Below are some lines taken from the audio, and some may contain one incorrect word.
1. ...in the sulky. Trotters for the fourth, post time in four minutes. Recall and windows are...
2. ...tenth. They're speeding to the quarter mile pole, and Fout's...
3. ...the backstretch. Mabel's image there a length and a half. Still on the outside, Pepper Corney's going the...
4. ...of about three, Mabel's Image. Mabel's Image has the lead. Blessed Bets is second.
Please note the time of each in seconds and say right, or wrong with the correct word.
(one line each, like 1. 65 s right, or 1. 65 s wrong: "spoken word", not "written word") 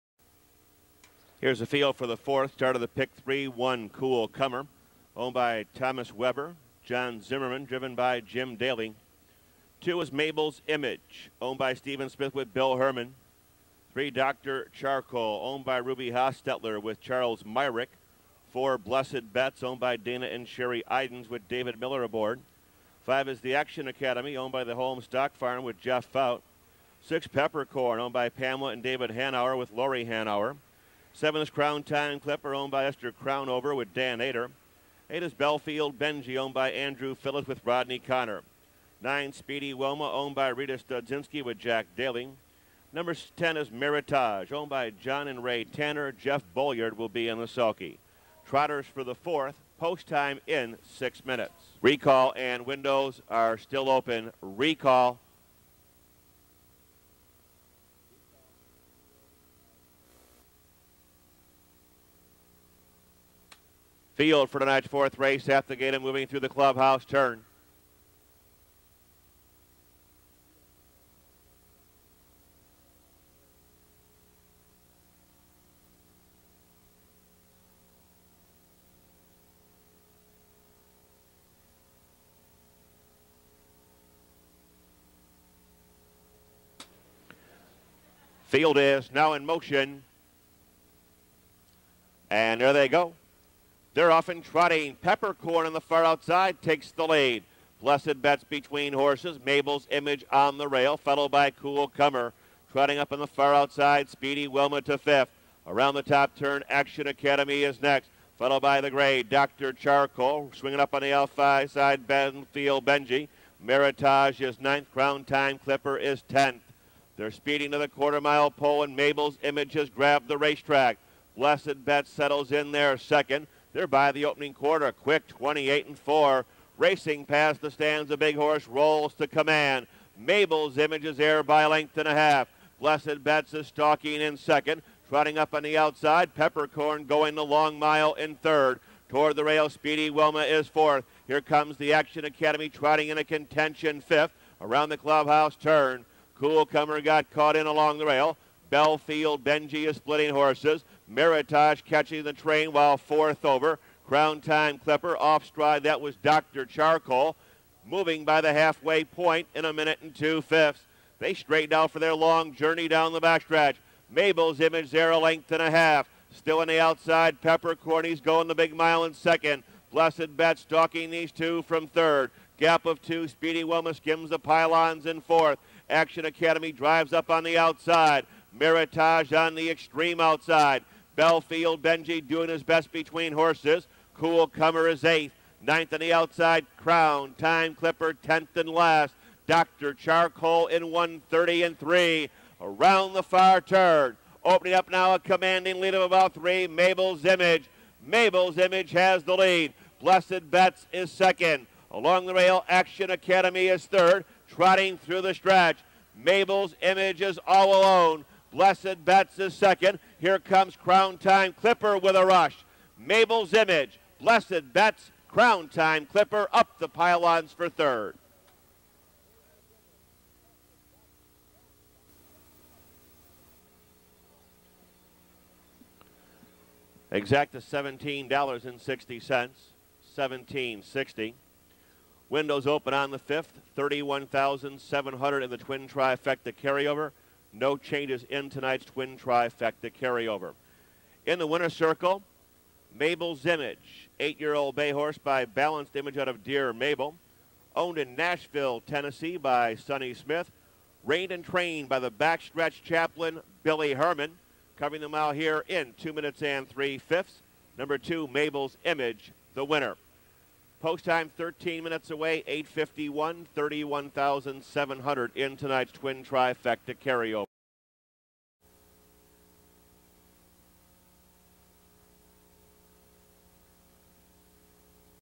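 1. 47 s wrong: "six", not "four"
2. 116 s wrong: "Mabel", not "Fout"
3. 163 s right
4. 195 s right.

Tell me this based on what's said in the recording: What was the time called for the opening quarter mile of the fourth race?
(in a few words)
28 and 4.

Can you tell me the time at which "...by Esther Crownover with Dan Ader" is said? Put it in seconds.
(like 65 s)
32 s.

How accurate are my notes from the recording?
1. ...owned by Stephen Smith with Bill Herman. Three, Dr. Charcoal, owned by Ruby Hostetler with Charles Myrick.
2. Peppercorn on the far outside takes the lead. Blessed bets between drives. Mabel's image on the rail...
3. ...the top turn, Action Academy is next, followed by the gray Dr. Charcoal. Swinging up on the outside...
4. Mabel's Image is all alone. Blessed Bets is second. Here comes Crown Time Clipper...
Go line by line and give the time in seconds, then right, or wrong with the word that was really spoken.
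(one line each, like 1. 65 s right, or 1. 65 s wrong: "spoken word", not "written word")
1. 11 s right
2. 94 s wrong: "horses", not "drives"
3. 105 s right
4. 206 s right.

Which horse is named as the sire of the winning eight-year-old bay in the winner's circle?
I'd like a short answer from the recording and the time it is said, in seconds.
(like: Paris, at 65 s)
Balanced Image, at 245 s.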